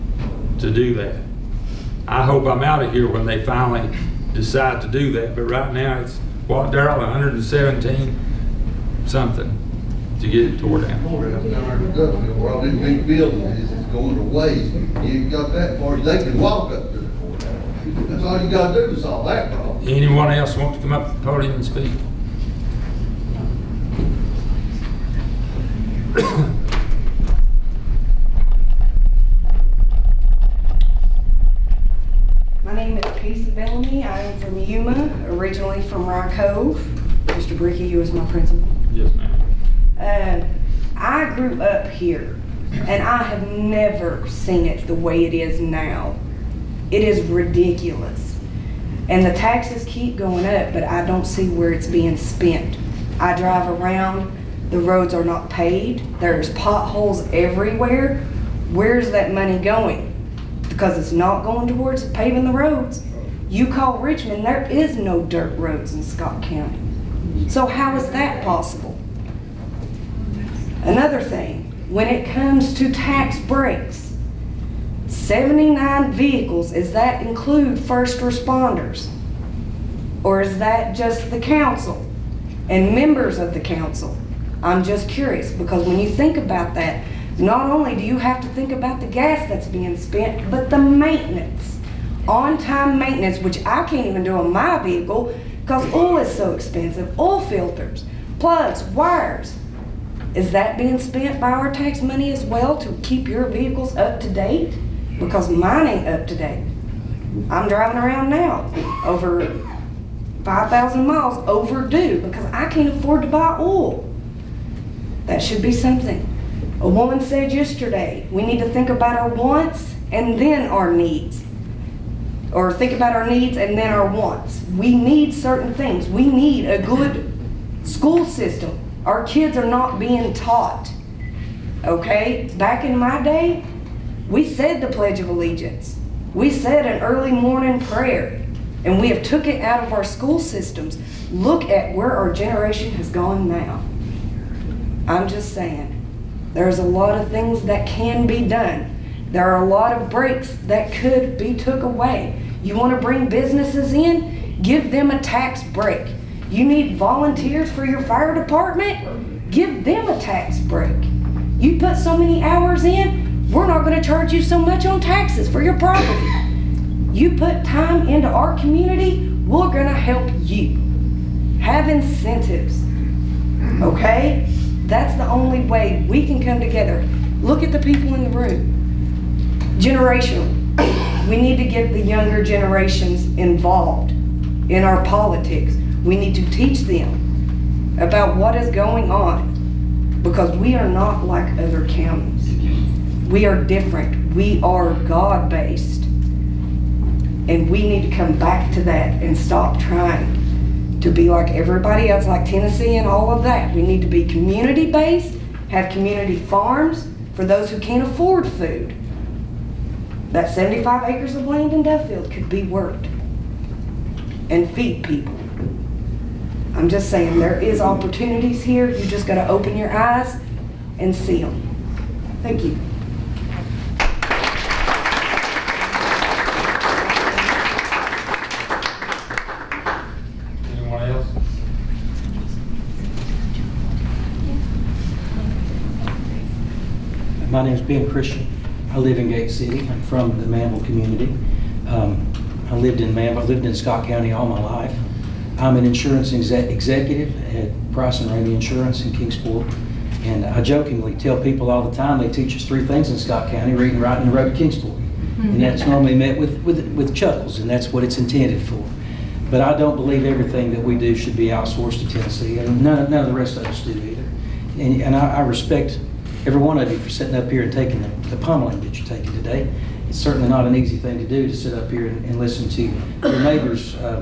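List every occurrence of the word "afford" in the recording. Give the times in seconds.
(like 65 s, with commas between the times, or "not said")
112 s, 208 s.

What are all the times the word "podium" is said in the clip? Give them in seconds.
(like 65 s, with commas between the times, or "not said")
21 s.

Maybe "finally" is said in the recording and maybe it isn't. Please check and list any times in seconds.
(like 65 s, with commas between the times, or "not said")
3 s.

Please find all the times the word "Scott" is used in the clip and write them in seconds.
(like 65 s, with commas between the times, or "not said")
66 s, 243 s, 253 s.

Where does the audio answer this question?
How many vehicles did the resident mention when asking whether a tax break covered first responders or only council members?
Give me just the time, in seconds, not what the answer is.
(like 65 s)
75 s.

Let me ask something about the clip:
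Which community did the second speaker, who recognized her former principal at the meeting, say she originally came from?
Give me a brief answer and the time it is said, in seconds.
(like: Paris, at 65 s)
Rye Cove, at 36 s.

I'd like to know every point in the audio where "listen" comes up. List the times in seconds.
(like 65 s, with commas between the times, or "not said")
272 s.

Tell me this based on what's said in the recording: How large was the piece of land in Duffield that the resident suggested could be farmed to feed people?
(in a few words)
75 acres.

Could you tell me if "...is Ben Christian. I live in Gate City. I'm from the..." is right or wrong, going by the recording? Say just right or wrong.
right.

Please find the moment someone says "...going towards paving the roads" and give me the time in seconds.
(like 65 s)
61 s.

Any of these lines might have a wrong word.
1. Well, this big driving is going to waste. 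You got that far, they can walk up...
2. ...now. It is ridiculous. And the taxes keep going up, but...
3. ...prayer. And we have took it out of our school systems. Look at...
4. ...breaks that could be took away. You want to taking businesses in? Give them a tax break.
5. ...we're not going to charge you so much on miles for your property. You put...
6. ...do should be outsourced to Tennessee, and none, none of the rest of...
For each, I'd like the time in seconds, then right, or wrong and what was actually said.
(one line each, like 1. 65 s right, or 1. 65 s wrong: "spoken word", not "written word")
1. 11 s wrong: "building", not "driving"
2. 45 s right
3. 137 s right
4. 150 s wrong: "bring", not "taking"
5. 163 s wrong: "taxes", not "miles"
6. 260 s right.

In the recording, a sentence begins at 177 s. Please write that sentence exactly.
Look at the people in the room.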